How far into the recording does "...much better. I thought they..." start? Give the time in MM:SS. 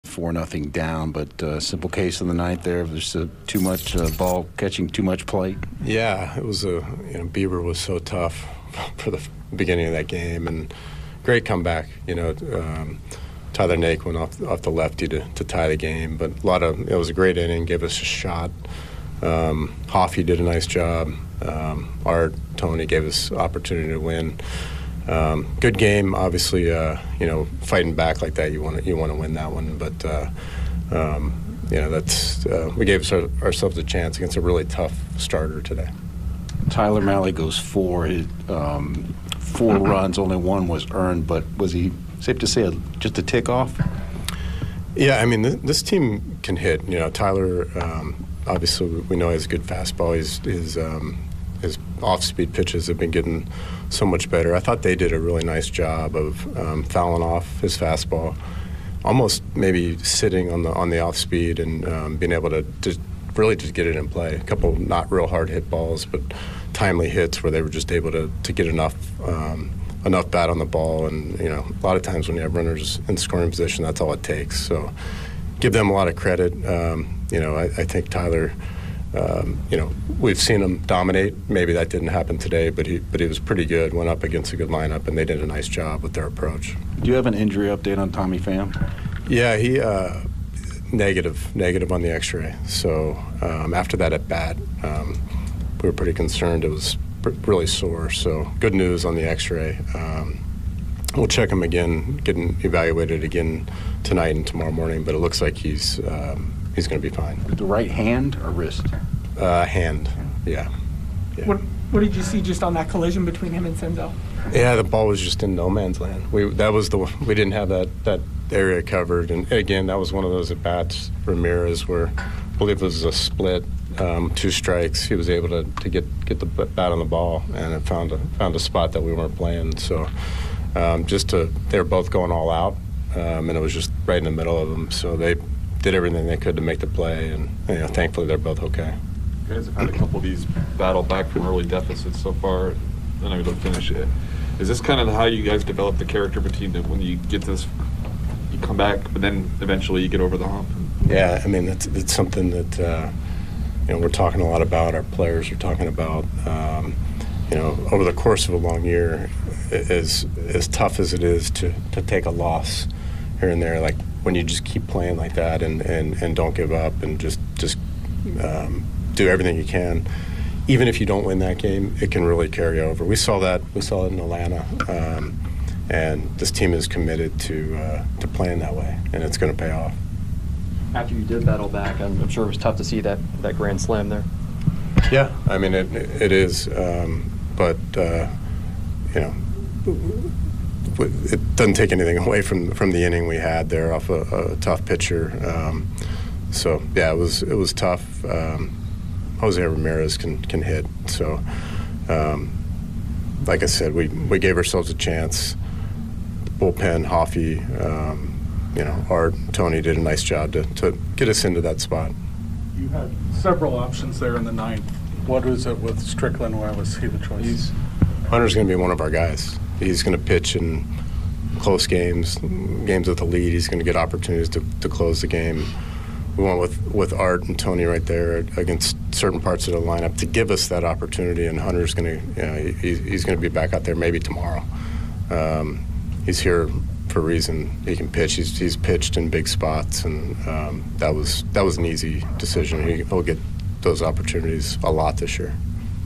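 00:54.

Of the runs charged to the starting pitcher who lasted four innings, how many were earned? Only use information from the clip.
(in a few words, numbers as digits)
1.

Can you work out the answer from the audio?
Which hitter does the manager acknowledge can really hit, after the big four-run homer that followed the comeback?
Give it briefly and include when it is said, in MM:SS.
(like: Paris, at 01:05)
Jose Ramirez, at 03:19.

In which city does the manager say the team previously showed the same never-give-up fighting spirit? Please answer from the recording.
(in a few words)
Atlanta.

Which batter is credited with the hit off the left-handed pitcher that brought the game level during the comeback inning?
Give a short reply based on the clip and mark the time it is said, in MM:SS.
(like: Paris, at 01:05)
Tyler Naquin, at 00:13.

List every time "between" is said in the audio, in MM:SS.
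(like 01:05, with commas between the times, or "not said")
01:53, 02:26.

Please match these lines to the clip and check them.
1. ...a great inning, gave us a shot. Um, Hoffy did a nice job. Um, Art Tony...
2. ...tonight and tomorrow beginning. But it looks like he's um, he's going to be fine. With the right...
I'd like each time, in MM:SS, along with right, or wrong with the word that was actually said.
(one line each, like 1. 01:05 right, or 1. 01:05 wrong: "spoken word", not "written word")
1. 00:17 right
2. 01:44 wrong: "morning", not "beginning".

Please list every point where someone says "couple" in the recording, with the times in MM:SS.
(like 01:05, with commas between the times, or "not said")
01:04, 02:19.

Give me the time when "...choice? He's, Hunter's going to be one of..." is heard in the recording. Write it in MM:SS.
03:37.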